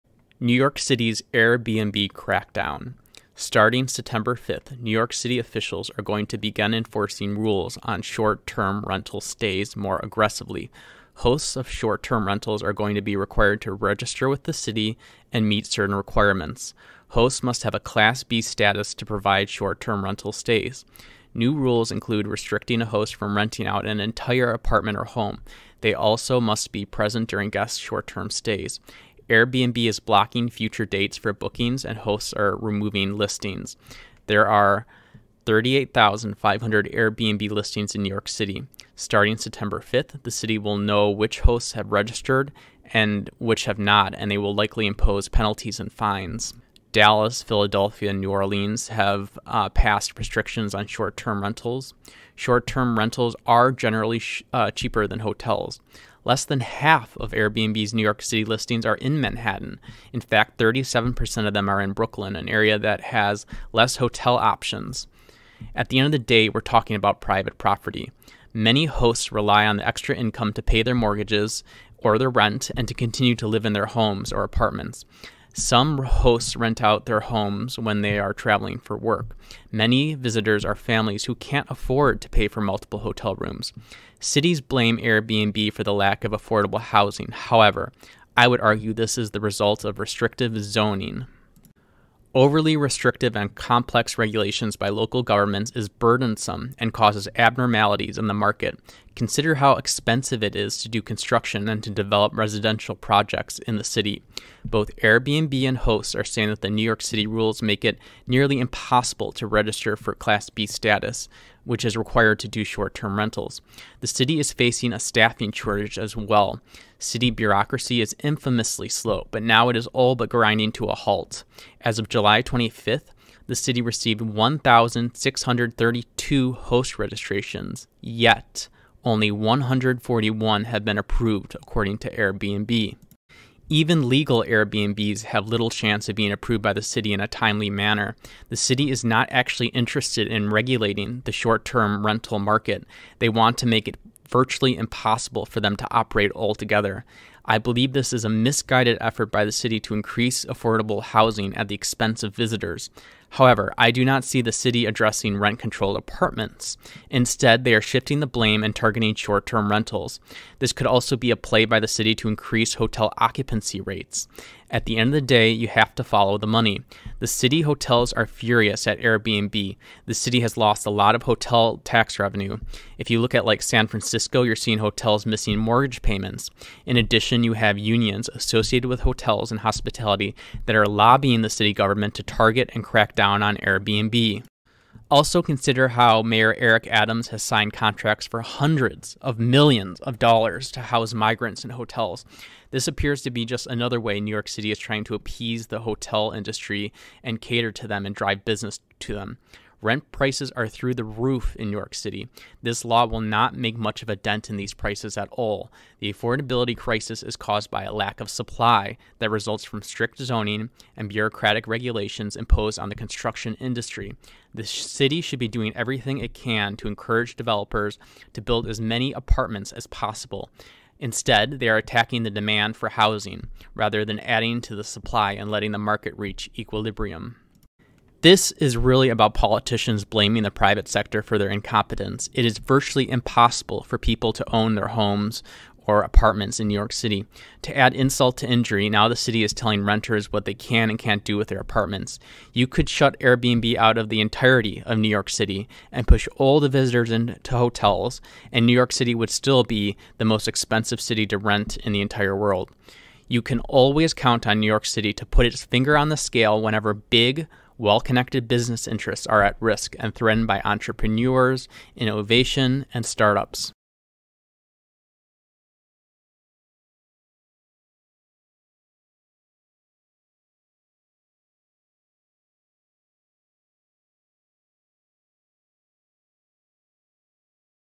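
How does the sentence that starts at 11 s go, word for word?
Hosts of short term rentals are going to be required to register with the city and meet certain requirements.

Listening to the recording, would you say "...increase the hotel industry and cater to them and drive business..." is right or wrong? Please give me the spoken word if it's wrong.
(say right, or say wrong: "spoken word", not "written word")
wrong: "appease", not "increase".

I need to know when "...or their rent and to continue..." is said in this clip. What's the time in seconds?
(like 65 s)
71 s.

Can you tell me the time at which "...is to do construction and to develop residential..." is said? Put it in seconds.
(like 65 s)
100 s.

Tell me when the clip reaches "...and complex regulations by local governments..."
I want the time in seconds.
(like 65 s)
93 s.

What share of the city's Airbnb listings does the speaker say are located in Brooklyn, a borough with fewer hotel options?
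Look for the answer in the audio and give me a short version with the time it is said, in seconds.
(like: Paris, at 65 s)
37%, at 60 s.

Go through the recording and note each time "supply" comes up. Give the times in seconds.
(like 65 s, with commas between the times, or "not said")
208 s, 224 s.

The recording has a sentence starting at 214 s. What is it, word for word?
The city should be doing everything it can to encourage developers to build as many apartments as possible.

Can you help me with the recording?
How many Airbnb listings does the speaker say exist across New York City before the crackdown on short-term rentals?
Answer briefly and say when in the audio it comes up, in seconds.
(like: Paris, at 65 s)
38,500, at 35 s.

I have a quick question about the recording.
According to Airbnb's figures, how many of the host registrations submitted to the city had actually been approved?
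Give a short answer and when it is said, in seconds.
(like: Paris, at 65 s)
141, at 129 s.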